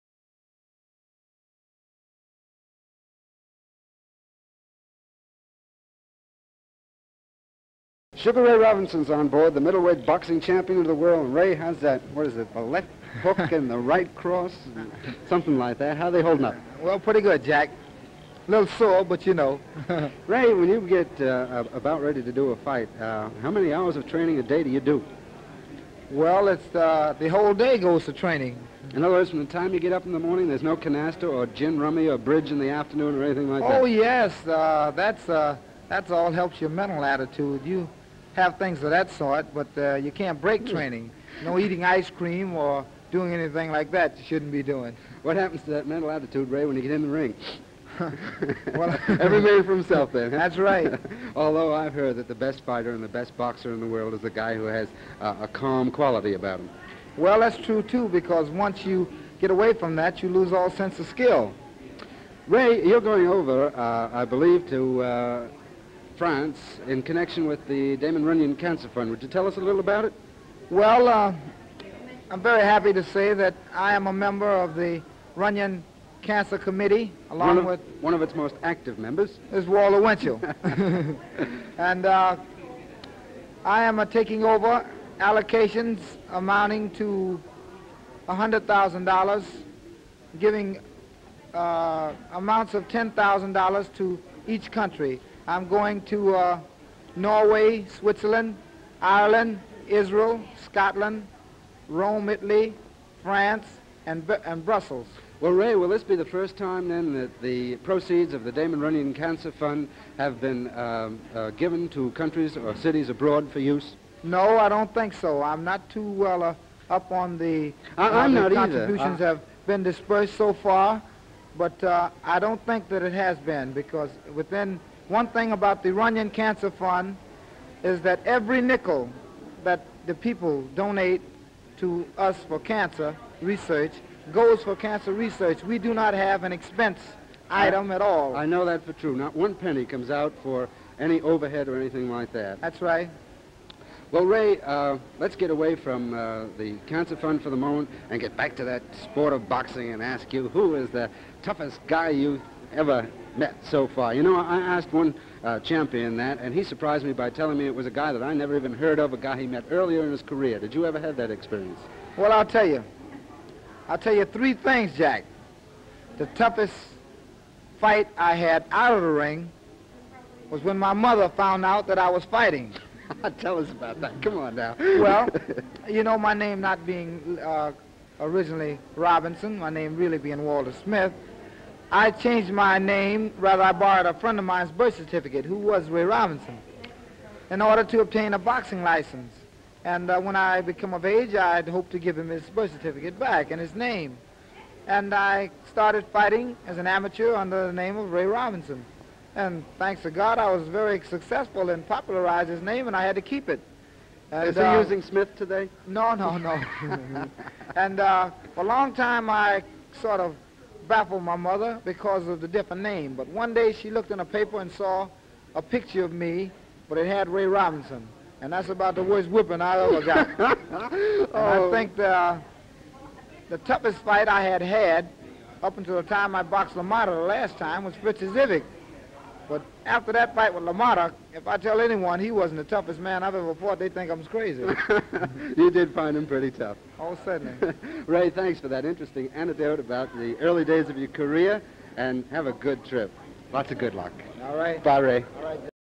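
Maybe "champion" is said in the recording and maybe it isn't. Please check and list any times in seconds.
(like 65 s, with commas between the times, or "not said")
10 s, 155 s.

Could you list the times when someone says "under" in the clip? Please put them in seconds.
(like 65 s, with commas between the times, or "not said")
197 s.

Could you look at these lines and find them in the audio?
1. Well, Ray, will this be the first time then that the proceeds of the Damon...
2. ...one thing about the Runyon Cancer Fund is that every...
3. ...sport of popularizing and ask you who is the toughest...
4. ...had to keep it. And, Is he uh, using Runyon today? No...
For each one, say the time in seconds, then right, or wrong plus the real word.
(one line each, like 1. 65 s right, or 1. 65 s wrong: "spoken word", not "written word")
1. 105 s right
2. 125 s right
3. 149 s wrong: "boxing", not "popularizing"
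4. 203 s wrong: "Smith", not "Runyon".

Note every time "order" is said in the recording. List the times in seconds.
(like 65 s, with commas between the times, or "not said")
187 s.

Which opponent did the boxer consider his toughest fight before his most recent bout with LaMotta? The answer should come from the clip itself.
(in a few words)
Fritz Zivic.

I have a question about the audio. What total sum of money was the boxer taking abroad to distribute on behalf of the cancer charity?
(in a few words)
$100,000.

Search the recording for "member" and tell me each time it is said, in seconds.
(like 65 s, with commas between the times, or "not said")
74 s, 78 s.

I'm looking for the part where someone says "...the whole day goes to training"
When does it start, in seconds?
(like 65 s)
27 s.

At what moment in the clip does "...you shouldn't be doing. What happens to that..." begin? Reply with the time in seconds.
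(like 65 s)
44 s.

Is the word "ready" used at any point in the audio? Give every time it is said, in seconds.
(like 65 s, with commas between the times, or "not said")
22 s.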